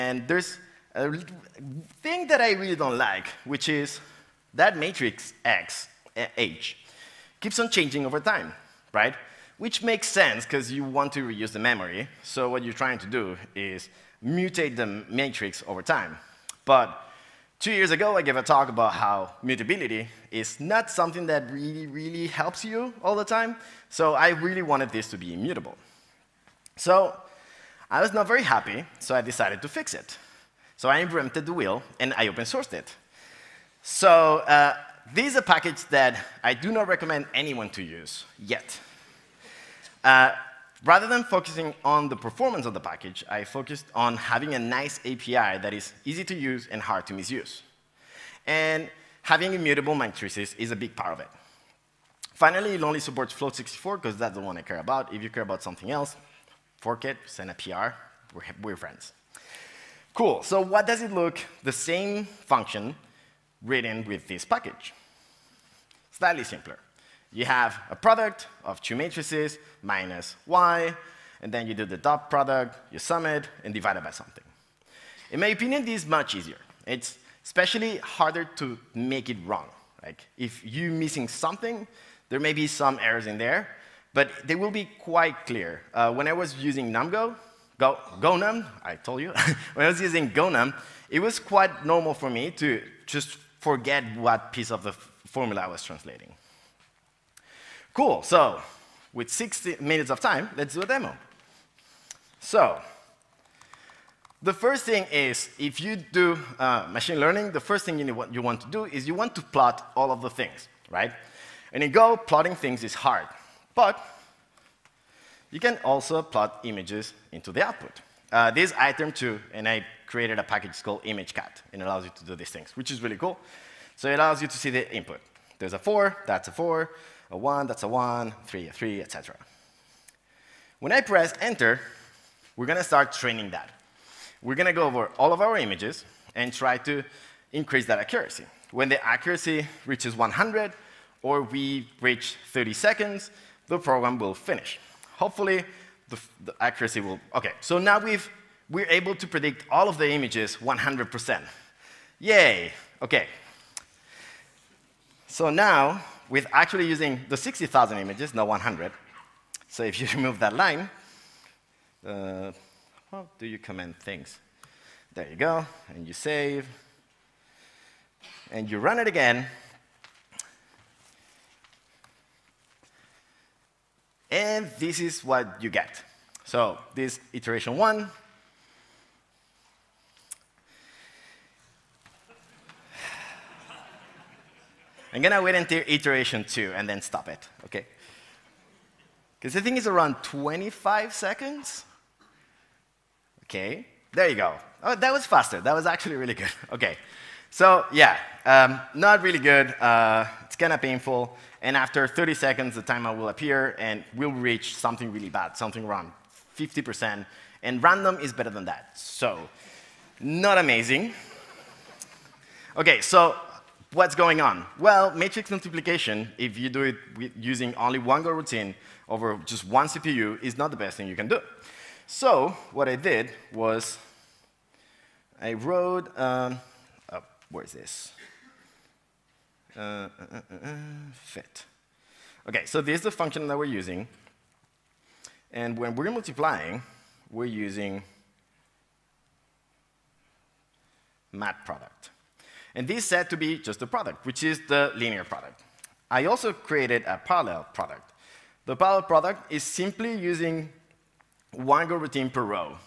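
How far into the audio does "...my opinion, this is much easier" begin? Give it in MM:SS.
01:15.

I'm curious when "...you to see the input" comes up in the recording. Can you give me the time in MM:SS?
02:04.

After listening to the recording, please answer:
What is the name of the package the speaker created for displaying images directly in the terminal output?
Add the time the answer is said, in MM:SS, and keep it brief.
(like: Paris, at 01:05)
ImageCat, at 02:01.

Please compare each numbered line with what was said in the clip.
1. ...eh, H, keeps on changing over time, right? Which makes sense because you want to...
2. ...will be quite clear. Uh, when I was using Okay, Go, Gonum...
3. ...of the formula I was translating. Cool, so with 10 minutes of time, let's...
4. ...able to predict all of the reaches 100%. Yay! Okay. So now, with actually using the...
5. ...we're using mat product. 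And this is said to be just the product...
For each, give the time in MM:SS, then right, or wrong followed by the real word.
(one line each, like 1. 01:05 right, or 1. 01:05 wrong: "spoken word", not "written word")
1. 00:06 right
2. 01:24 wrong: "NumGo", not "Okay"
3. 01:34 wrong: "60", not "10"
4. 02:28 wrong: "images", not "reaches"
5. 03:57 right.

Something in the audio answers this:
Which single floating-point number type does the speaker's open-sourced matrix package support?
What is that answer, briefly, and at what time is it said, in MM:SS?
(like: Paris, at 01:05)
Float64, at 00:53.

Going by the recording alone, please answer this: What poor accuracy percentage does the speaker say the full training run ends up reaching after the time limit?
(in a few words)
50%.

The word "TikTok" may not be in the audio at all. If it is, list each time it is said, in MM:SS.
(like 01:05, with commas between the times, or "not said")
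not said.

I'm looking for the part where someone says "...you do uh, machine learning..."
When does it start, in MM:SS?
01:45.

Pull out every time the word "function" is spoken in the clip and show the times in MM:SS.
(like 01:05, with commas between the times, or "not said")
01:02, 03:53.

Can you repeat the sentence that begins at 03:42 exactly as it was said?
So what I did was I wrote um, where is this?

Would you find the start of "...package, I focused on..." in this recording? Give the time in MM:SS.
00:42.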